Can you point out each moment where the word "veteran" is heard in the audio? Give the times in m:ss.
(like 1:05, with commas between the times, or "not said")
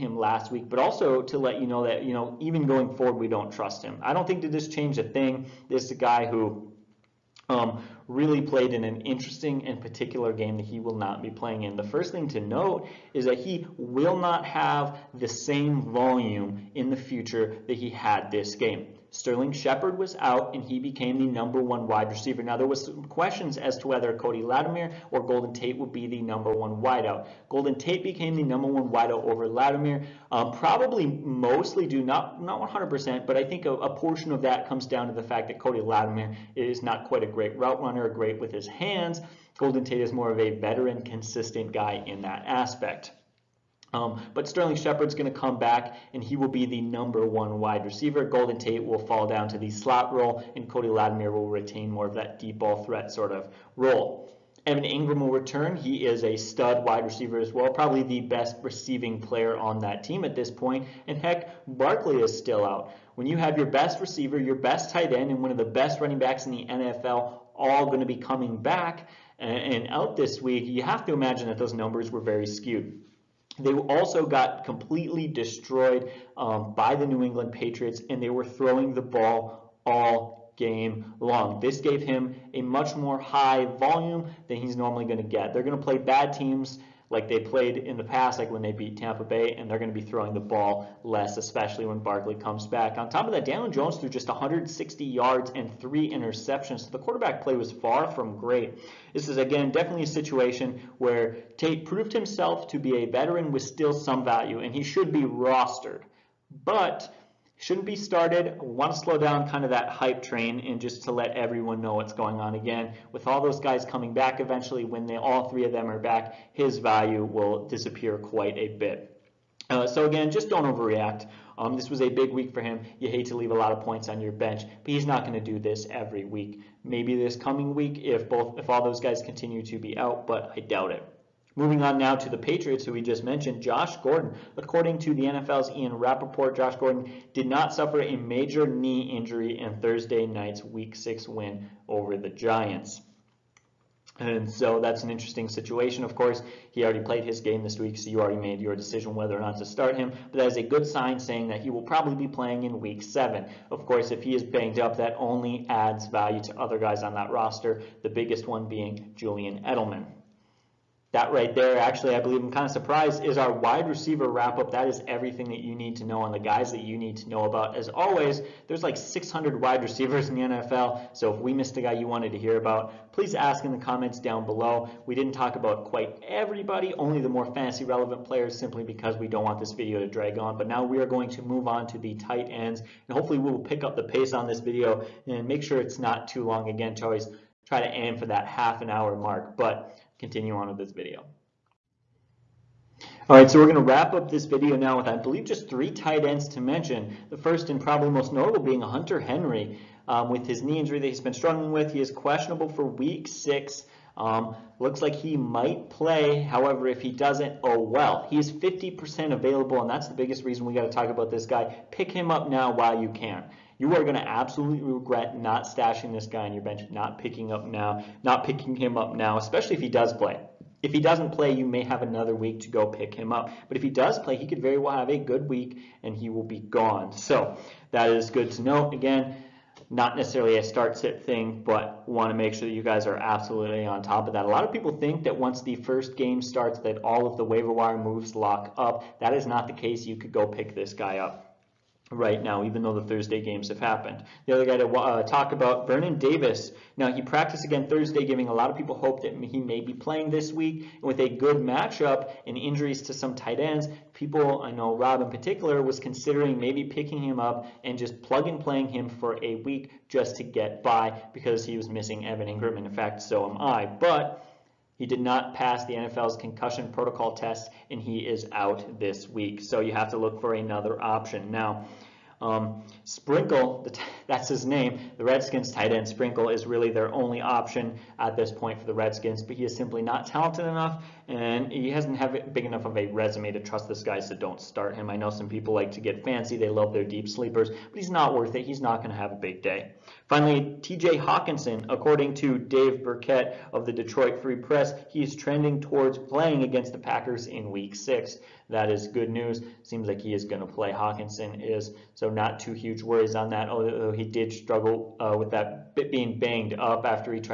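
0:40, 1:43.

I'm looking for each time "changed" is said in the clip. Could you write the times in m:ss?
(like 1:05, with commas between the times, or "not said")
0:04.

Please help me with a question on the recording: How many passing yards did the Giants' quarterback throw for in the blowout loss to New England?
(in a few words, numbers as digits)
160.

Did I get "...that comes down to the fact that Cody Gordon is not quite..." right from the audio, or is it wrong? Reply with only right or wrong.
wrong.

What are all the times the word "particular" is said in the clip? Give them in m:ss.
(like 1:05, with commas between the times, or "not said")
0:09, 4:15.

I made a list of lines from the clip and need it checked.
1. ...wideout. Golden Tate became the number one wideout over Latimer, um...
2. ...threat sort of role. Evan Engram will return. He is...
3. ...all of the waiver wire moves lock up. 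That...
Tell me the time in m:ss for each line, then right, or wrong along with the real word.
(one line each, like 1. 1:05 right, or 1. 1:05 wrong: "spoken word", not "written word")
1. 0:26 right
2. 0:52 right
3. 3:57 right.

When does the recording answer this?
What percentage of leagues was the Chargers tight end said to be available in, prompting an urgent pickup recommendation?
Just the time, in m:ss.
3:28.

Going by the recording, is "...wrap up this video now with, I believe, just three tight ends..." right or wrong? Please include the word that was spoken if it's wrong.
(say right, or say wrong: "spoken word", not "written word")
right.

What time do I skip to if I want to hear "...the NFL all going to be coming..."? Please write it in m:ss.
1:06.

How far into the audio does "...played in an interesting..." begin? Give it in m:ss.
0:08.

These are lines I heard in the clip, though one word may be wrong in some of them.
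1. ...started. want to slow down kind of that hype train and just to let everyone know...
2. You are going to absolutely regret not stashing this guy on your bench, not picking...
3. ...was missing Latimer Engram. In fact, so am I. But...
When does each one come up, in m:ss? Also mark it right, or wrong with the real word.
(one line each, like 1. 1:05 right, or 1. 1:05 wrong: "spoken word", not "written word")
1. 1:47 right
2. 3:33 right
3. 4:21 wrong: "Evan", not "Latimer".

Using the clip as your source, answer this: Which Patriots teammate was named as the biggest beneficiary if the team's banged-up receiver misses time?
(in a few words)
Julian Edelman.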